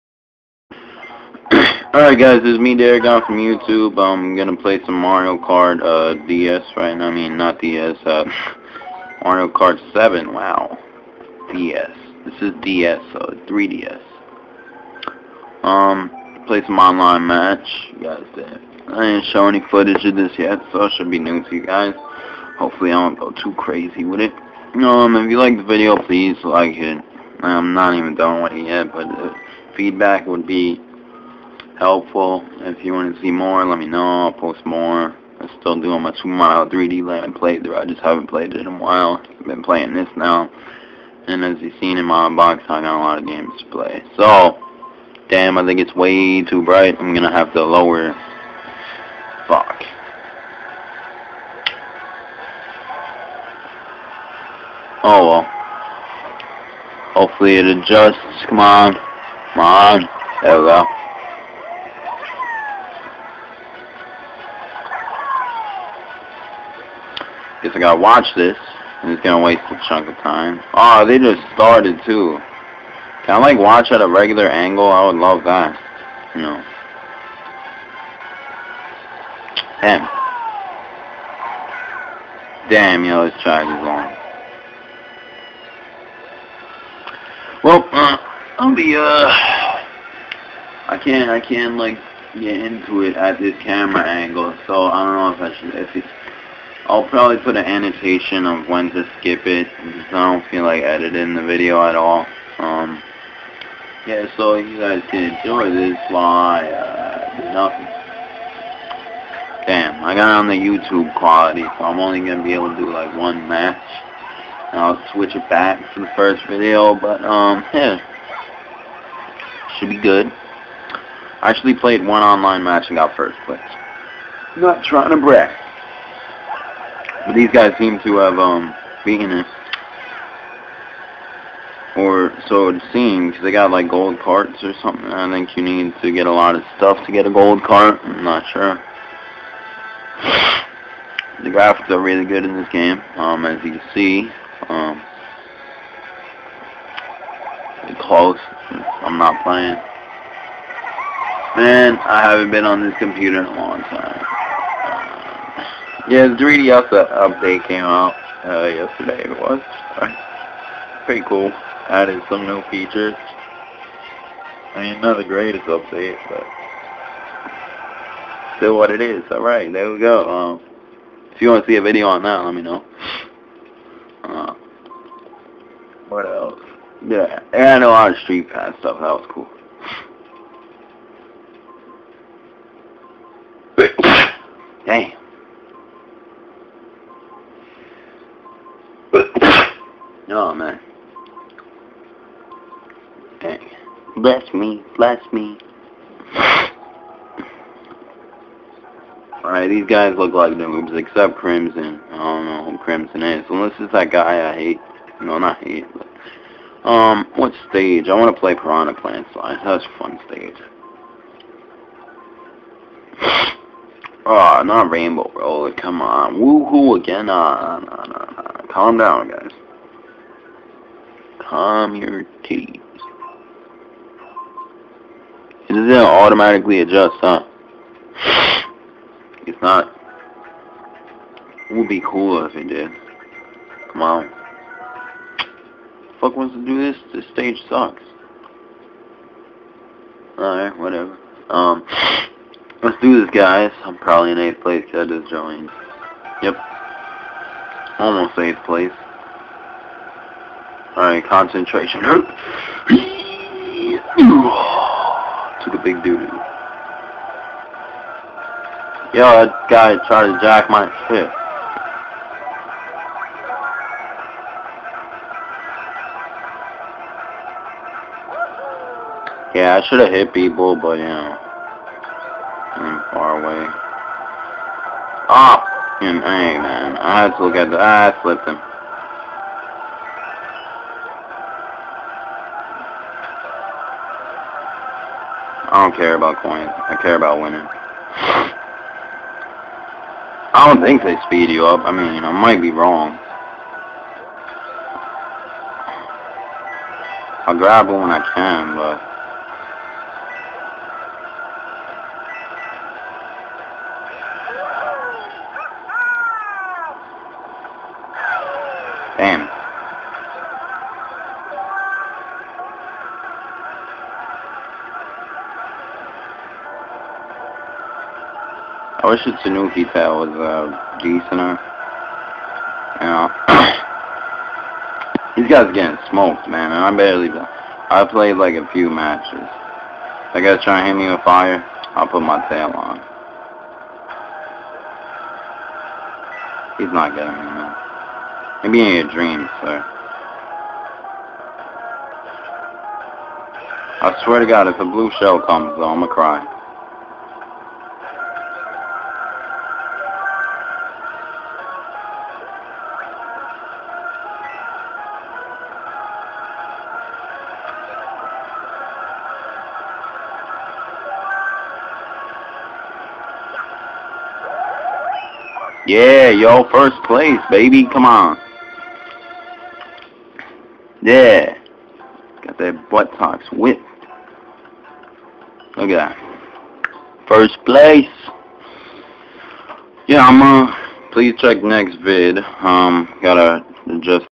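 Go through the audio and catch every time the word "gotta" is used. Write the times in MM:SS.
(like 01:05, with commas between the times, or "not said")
01:07, 06:23.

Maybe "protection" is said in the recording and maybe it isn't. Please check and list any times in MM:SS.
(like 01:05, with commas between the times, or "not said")
not said.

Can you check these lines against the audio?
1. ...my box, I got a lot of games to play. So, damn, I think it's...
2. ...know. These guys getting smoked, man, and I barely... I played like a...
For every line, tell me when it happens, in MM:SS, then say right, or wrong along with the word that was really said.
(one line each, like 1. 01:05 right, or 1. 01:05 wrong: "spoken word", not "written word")
1. 00:42 right
2. 05:23 right.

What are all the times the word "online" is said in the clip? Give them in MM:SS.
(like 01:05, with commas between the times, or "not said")
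00:16, 02:02.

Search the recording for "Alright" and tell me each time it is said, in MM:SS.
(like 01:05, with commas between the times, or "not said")
00:01, 03:19, 04:00, 04:10.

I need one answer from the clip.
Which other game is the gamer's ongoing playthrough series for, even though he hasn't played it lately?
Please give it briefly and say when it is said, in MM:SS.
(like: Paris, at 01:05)
Super Mario 3D Land, at 00:36.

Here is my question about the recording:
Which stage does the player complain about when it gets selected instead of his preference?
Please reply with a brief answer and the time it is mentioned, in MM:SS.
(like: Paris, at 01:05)
Rainbow Roller, at 03:34.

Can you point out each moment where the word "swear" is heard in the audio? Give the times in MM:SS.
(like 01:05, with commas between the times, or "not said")
05:44.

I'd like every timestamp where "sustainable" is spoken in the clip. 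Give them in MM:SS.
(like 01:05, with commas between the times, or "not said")
not said.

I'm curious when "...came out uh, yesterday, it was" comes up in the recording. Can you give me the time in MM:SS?
02:37.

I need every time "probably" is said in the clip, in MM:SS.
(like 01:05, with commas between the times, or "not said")
01:37, 04:03.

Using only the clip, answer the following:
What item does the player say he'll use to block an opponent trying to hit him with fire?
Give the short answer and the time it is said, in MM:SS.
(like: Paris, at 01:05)
tail, at 05:32.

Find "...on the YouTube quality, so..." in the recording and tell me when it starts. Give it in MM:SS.
01:50.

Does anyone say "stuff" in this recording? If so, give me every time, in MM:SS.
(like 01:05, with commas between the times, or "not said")
02:16, 02:58.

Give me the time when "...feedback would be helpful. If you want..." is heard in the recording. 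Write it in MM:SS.
00:29.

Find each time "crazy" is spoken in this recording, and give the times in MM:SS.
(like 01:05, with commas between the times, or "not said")
00:23.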